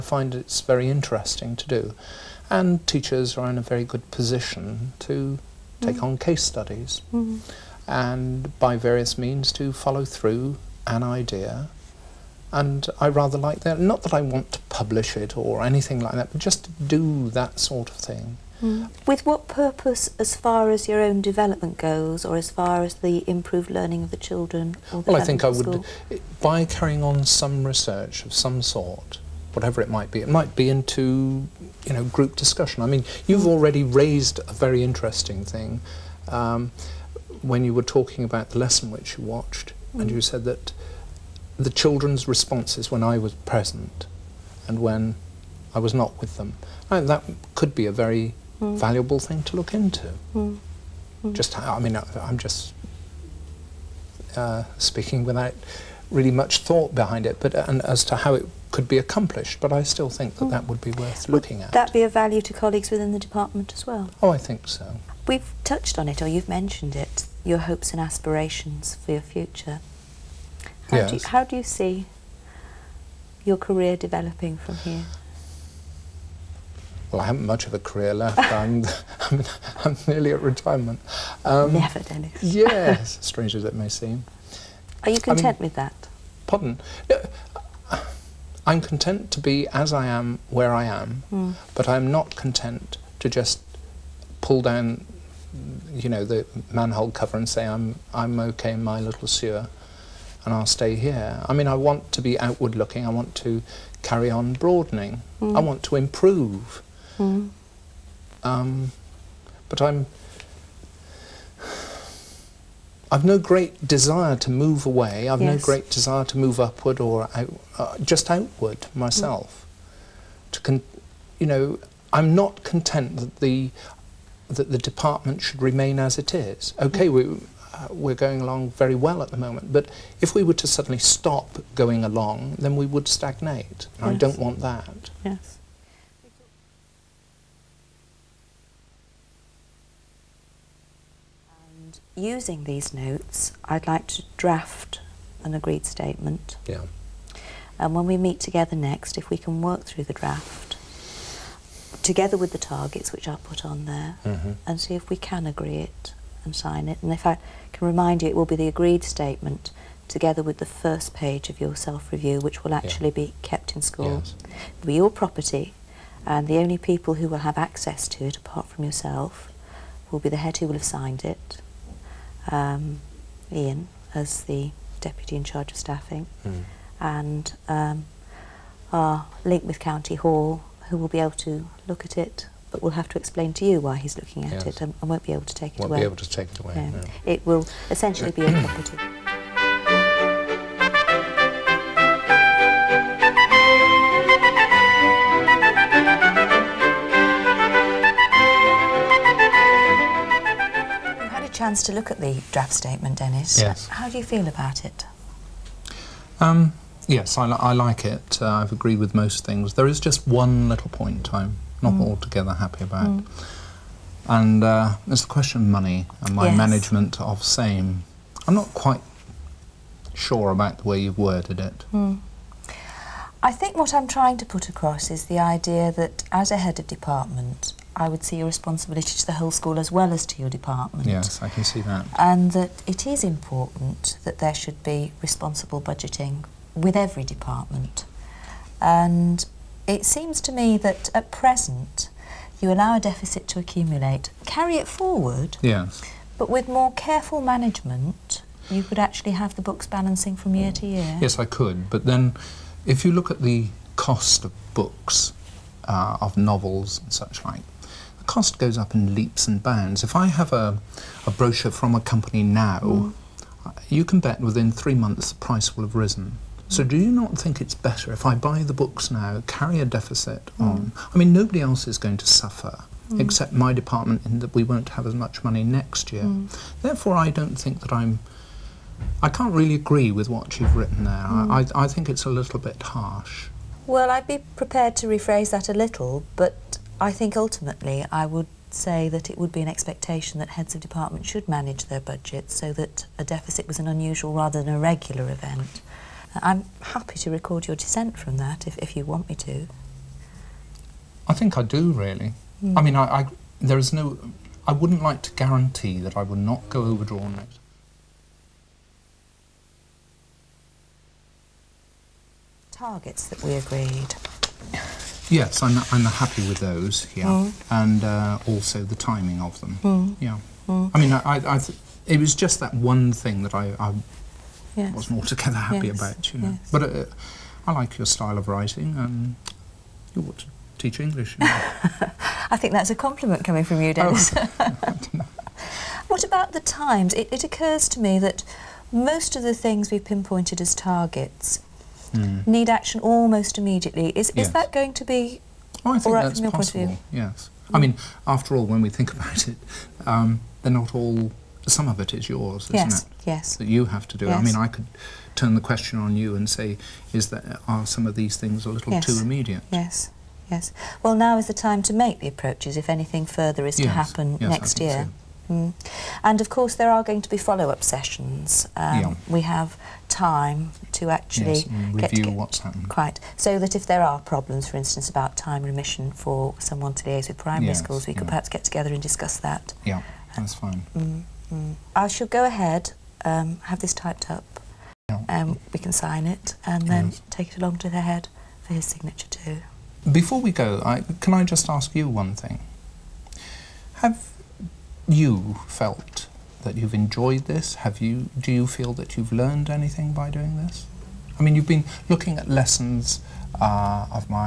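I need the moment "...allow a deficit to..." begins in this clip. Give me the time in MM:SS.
04:02.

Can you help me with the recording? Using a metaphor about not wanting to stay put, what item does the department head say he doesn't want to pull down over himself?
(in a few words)
manhole cover.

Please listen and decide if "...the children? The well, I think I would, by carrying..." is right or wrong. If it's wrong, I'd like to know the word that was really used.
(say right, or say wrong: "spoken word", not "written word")
right.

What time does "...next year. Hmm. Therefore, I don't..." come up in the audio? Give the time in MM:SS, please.
04:35.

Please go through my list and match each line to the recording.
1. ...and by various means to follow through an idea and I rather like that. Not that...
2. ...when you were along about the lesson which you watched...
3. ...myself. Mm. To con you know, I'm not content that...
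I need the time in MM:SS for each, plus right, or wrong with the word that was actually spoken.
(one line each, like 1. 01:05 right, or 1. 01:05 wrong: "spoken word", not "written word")
1. 00:07 right
2. 00:37 wrong: "talking", not "along"
3. 01:58 right.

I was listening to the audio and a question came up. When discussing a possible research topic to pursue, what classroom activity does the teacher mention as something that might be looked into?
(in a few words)
group discussion.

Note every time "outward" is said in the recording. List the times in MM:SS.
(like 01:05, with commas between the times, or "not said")
01:42, 01:58.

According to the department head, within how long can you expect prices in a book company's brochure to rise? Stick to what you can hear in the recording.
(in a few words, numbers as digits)
3 months.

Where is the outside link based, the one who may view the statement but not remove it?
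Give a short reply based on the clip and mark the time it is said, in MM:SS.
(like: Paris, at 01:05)
County Hall, at 02:59.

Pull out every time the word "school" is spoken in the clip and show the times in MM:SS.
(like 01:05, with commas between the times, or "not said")
02:43, 03:49, 06:17.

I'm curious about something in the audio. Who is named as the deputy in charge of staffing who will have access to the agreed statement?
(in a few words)
Ian.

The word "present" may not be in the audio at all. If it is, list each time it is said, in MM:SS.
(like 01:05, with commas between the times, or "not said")
00:43, 04:01.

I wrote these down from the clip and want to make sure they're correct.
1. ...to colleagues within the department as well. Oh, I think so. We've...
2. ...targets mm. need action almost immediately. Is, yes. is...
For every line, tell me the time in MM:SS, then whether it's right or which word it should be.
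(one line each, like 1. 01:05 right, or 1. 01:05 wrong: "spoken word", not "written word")
1. 01:02 right
2. 05:40 right.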